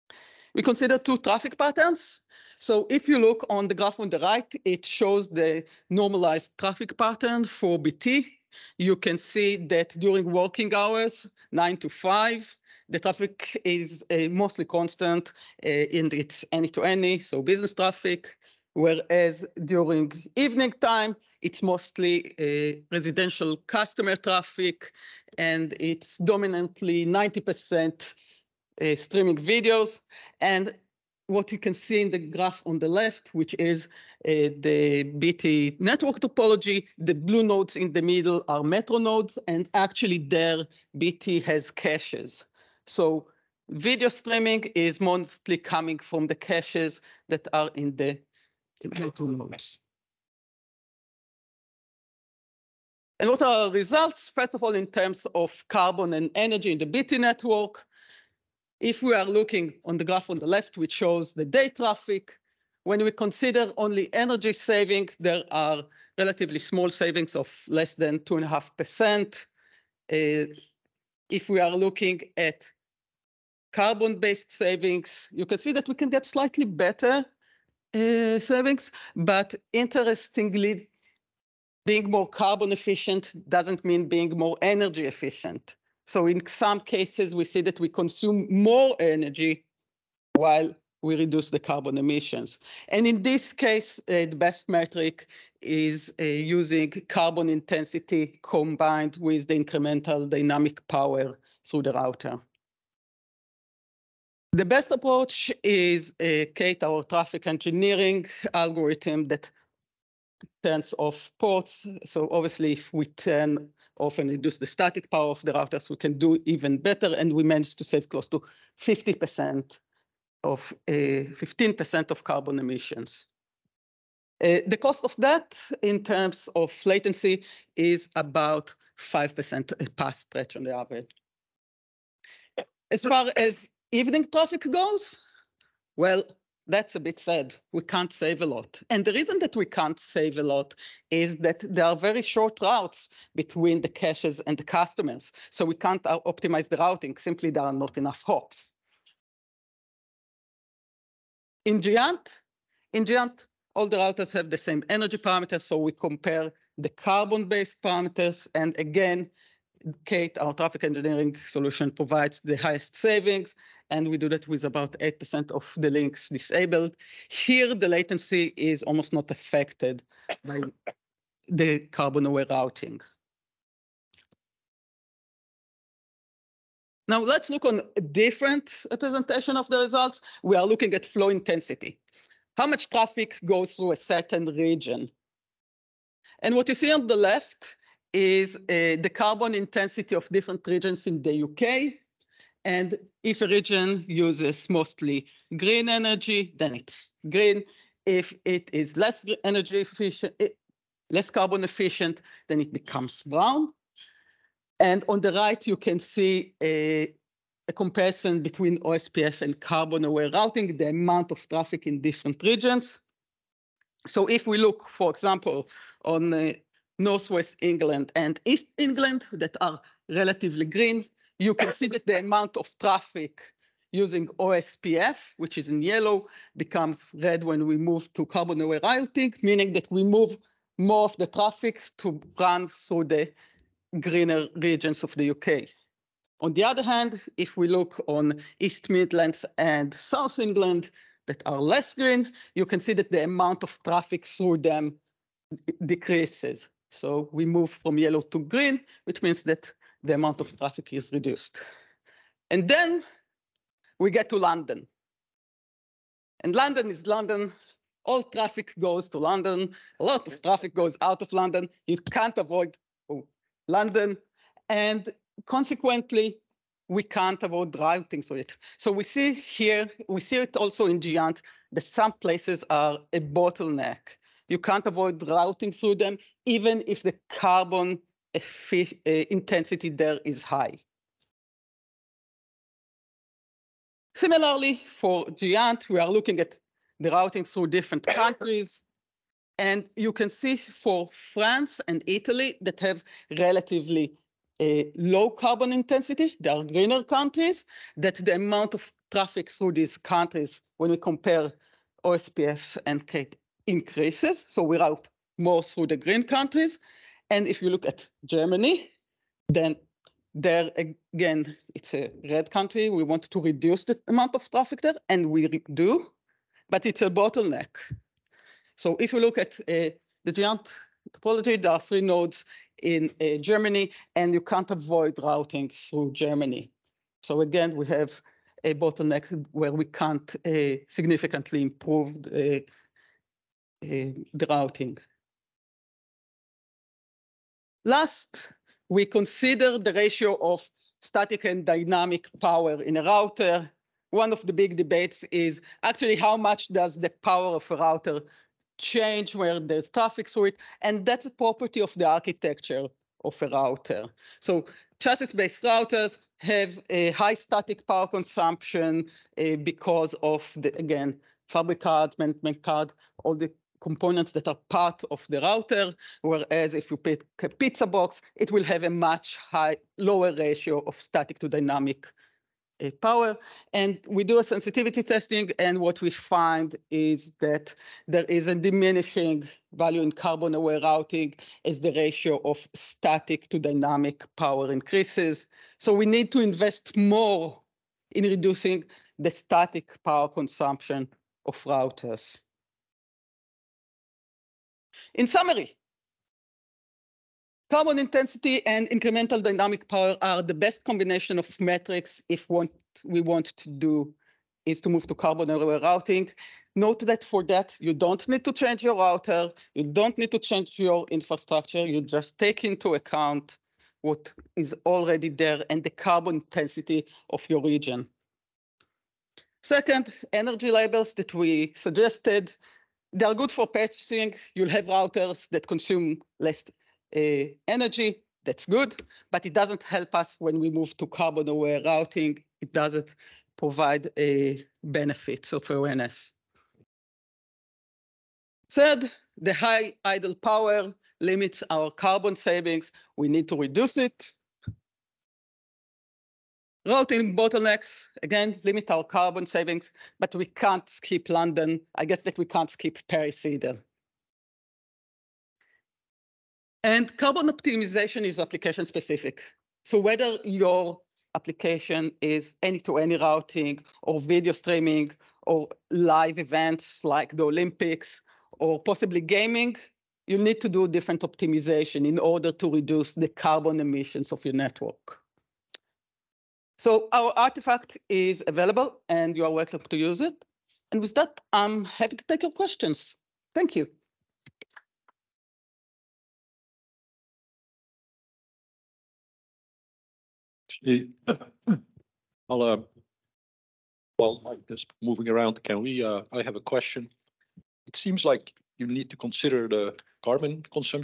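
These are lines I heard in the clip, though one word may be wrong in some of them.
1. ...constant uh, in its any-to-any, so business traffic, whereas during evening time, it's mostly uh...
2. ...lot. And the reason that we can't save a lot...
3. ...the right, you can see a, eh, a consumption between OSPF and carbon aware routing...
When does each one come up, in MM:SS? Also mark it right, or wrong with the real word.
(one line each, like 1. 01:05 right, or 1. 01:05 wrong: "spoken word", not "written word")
1. 00:14 right
2. 02:18 right
3. 03:25 wrong: "comparison", not "consumption".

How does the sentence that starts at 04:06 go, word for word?
So we move from yellow to green, which means that the amount of traffic is reduced.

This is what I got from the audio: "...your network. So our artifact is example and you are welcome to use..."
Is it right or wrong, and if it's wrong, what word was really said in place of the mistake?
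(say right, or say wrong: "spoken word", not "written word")
wrong: "available", not "example".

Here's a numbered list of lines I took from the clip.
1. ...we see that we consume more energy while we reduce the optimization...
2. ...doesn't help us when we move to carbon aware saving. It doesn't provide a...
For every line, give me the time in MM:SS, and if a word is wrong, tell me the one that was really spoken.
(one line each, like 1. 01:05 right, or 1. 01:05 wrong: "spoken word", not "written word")
1. 01:27 wrong: "carbon", not "optimization"
2. 07:09 wrong: "routing", not "saving".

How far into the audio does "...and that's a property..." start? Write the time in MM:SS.
05:50.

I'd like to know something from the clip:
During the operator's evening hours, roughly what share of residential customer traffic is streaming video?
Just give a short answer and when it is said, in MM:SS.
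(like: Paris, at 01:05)
90%, at 00:27.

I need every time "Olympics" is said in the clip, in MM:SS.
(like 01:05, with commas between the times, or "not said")
07:47.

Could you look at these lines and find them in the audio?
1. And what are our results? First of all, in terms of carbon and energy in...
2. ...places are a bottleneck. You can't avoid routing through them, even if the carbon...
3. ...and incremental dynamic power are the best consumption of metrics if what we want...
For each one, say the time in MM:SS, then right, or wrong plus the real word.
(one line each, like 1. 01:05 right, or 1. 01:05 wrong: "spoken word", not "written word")
1. 00:53 right
2. 04:32 right
3. 06:38 wrong: "combination", not "consumption".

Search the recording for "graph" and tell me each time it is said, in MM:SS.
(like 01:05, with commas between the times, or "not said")
00:03, 00:32, 01:00.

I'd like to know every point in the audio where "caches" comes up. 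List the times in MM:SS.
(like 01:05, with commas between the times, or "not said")
00:41, 00:46, 02:23.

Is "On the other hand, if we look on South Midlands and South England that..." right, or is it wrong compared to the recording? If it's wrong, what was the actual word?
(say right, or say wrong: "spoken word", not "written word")
wrong: "East", not "South".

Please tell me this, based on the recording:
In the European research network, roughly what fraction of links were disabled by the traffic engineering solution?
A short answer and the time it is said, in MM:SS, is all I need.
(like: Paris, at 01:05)
8%, at 02:44.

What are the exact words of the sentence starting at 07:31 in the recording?
I guess that we can't skip Paris either.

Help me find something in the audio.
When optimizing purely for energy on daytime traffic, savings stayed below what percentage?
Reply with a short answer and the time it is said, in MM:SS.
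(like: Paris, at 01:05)
2.5%, at 01:08.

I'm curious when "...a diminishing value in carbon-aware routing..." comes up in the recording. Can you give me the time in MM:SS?
06:18.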